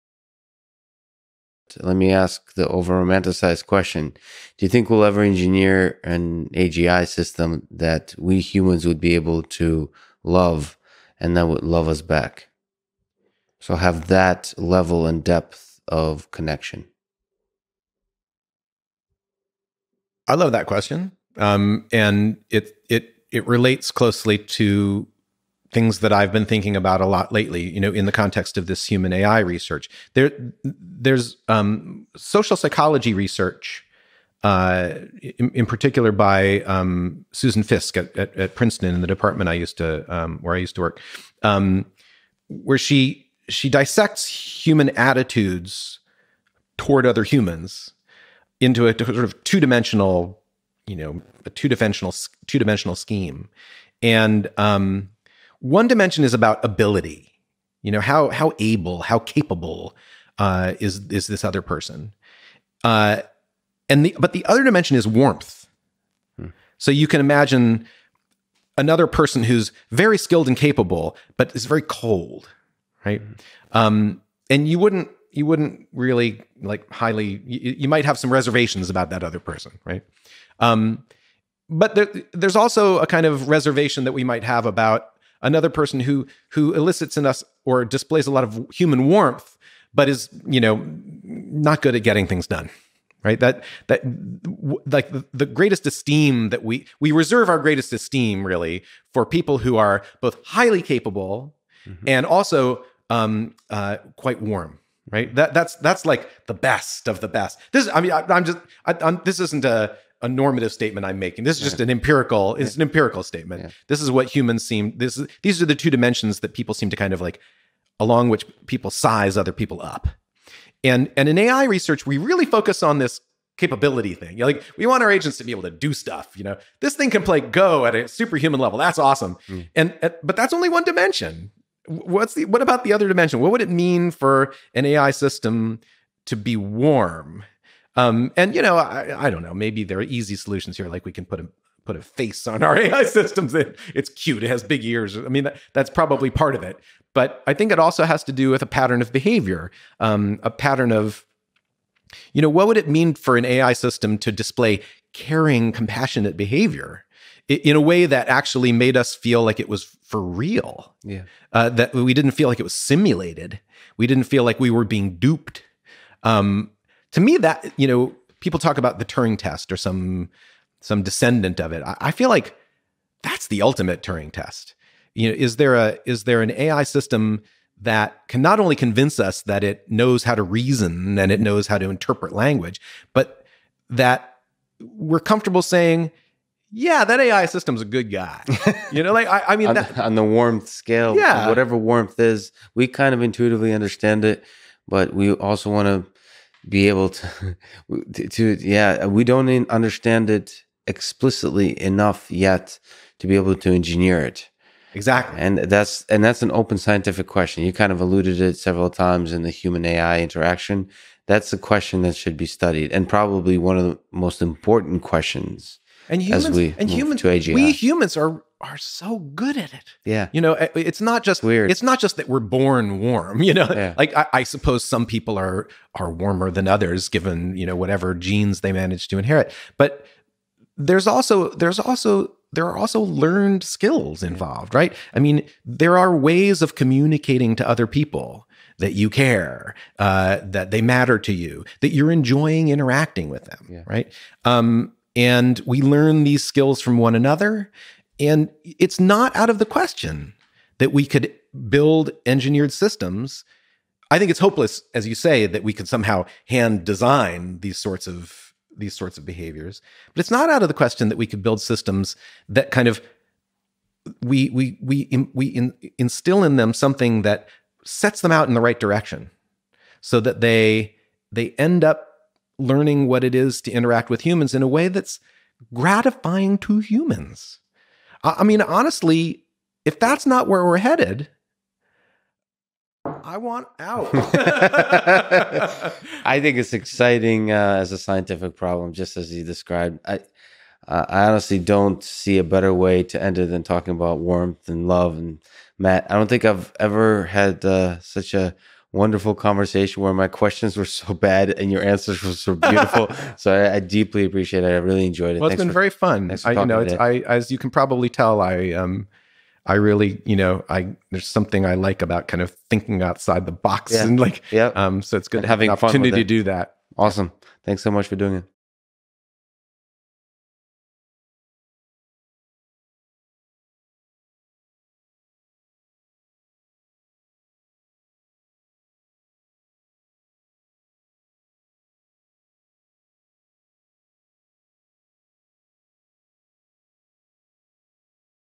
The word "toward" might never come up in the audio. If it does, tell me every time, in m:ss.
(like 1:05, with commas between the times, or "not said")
0:46.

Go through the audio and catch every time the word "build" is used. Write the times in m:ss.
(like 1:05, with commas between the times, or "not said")
4:11, 4:21.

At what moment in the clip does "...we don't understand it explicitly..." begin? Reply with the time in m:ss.
3:19.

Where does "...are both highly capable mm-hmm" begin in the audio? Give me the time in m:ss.
1:39.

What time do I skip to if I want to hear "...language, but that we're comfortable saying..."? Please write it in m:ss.
3:02.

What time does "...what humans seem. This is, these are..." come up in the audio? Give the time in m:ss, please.
1:54.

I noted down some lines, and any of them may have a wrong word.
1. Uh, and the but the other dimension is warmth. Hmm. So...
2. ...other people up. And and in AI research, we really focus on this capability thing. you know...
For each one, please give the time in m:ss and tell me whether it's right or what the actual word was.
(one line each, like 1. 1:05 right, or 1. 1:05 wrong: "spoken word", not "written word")
1. 1:02 right
2. 1:59 right.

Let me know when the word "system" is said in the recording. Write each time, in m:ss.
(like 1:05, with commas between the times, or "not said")
0:07, 2:15, 2:23, 2:33, 2:56, 3:07, 4:12, 4:21.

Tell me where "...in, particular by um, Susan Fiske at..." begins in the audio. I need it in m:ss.
0:35.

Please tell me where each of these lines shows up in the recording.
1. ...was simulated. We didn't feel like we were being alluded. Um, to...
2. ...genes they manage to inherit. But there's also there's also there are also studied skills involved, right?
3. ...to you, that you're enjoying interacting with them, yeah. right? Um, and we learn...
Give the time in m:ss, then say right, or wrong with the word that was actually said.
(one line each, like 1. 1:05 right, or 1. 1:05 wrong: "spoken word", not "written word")
1. 2:42 wrong: "duped", not "alluded"
2. 3:48 wrong: "learned", not "studied"
3. 4:01 right.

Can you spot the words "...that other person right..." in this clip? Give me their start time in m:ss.
1:19.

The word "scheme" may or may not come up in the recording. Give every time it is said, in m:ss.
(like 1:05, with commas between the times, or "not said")
0:52.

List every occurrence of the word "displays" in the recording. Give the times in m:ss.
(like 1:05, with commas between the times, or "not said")
1:27, 2:34.